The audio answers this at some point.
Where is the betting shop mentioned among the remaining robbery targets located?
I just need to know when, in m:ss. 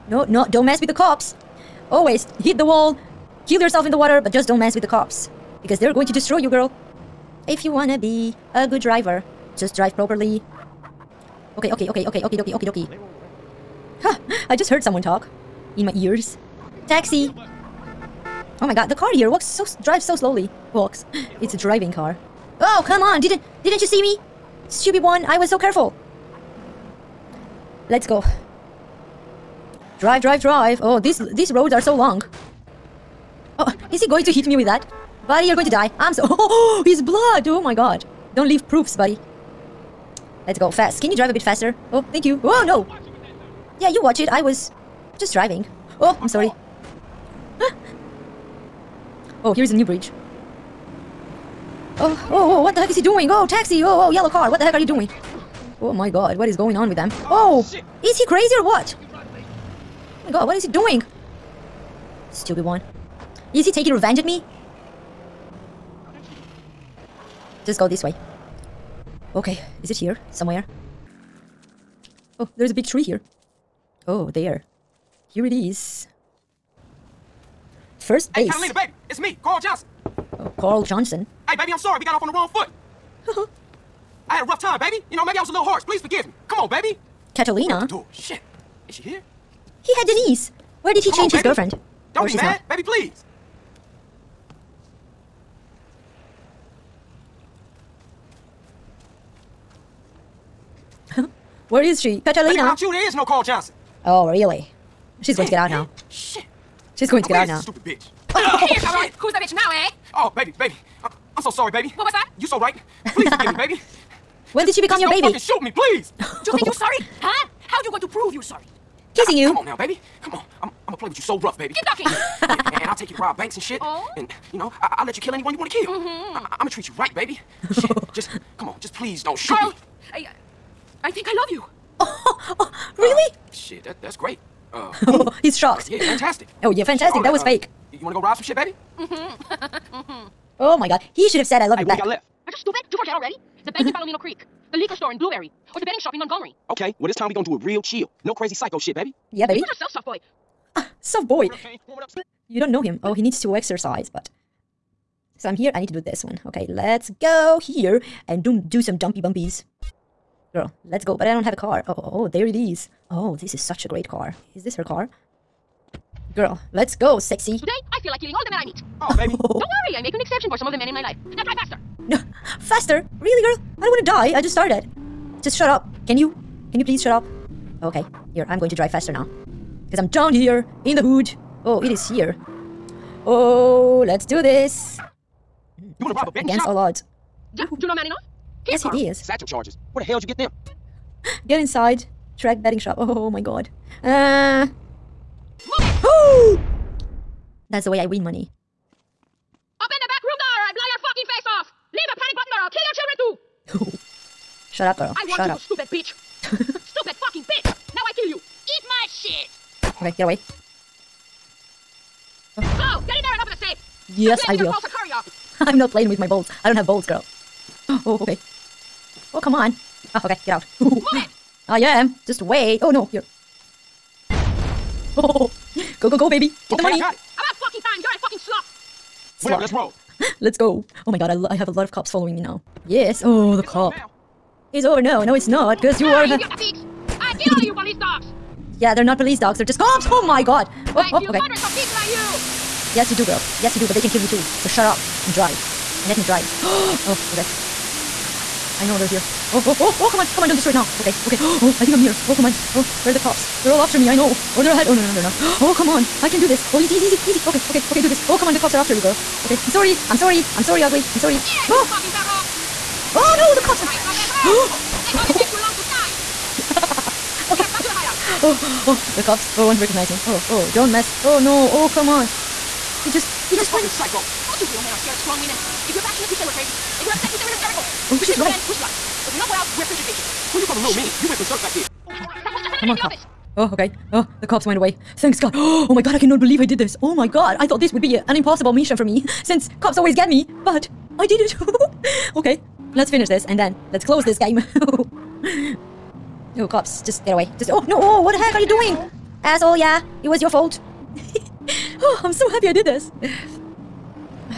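2:26.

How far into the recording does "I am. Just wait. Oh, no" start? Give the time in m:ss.
3:41.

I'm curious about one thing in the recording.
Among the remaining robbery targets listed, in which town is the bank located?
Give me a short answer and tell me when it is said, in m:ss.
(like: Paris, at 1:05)
Palomino Creek, at 2:23.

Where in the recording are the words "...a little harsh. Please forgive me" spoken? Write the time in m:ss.
1:25.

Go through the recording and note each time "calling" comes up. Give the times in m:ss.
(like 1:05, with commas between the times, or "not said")
4:40.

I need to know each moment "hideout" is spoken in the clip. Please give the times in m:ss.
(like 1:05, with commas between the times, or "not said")
4:27.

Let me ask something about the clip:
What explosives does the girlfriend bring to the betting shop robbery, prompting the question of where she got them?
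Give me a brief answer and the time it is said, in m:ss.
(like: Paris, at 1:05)
Satchel charges, at 3:09.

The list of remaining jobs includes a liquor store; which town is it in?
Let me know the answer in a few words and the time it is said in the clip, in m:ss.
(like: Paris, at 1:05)
Blueberry, at 2:25.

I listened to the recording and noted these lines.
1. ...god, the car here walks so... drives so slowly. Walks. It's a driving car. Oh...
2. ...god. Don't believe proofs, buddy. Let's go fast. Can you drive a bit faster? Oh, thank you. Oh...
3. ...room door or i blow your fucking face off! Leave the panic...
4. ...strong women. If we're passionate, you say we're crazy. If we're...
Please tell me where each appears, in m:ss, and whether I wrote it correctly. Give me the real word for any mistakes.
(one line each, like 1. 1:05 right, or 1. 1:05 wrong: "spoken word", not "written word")
1. 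0:18 right
2. 0:37 wrong: "leave", not "believe"
3. 3:20 right
4. 4:35 right.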